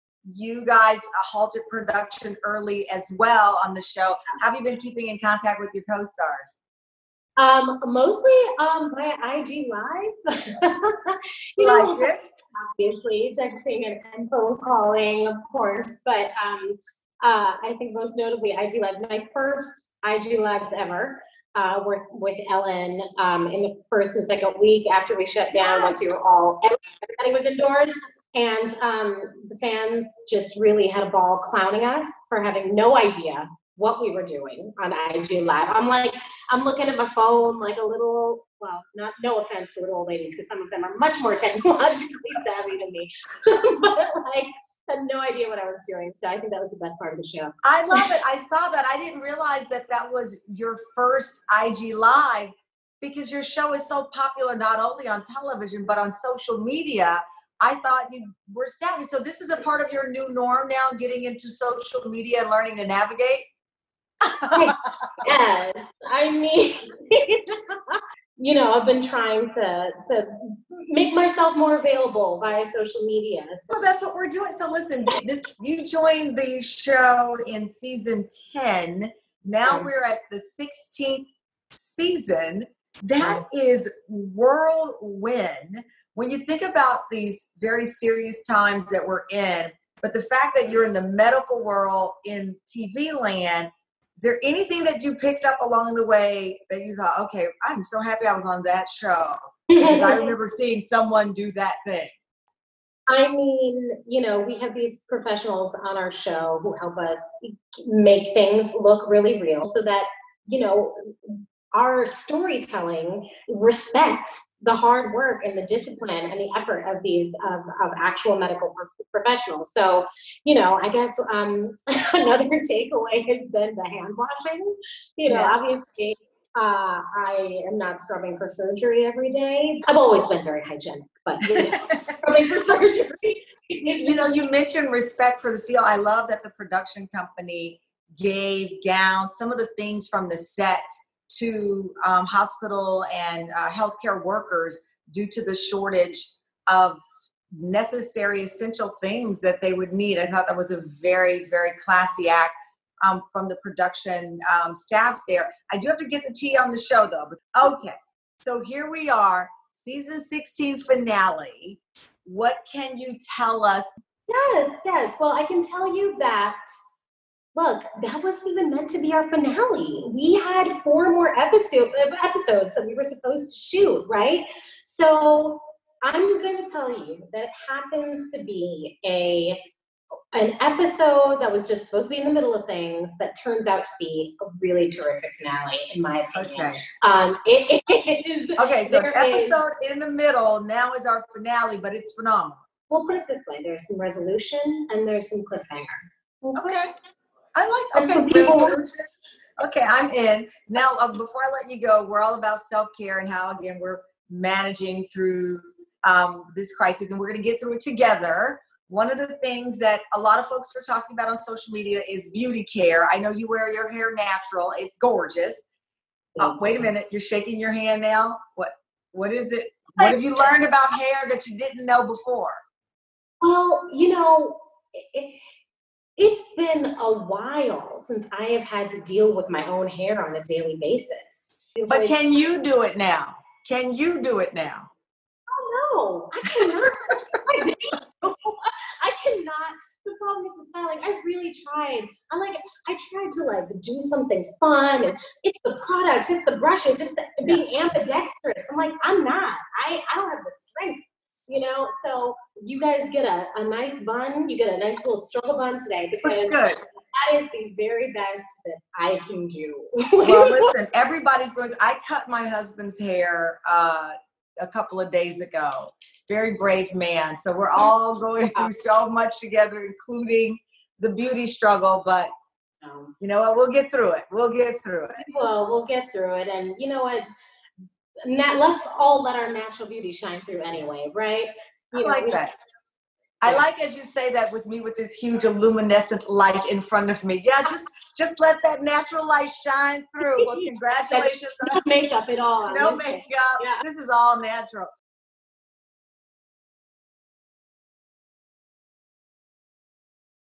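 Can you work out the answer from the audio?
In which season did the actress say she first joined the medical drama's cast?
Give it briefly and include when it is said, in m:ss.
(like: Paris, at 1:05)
Season 10, at 1:17.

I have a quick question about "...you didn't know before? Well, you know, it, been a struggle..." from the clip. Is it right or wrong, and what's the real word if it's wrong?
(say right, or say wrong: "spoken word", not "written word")
wrong: "while", not "struggle".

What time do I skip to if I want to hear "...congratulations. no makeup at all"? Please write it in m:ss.
4:50.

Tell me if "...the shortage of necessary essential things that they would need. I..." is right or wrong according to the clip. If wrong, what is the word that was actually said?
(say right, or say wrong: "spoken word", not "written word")
right.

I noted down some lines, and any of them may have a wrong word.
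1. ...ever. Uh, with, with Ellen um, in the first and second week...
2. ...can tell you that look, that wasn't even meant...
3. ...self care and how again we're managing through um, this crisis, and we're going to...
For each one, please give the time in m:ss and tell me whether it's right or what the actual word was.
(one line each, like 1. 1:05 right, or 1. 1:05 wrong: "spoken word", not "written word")
1. 0:20 right
2. 2:45 right
3. 3:22 right.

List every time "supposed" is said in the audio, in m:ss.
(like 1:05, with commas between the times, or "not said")
2:53, 3:01.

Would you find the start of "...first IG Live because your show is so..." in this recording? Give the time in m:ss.
0:50.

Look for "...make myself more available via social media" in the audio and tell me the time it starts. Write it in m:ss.
1:10.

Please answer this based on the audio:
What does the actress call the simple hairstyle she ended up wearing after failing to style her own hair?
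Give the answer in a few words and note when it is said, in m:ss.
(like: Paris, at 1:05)
Struggle bun, at 4:15.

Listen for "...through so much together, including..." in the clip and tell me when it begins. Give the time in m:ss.
4:28.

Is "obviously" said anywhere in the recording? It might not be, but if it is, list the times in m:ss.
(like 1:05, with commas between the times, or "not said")
0:12, 2:05.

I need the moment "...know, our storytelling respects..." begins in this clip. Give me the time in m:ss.
1:50.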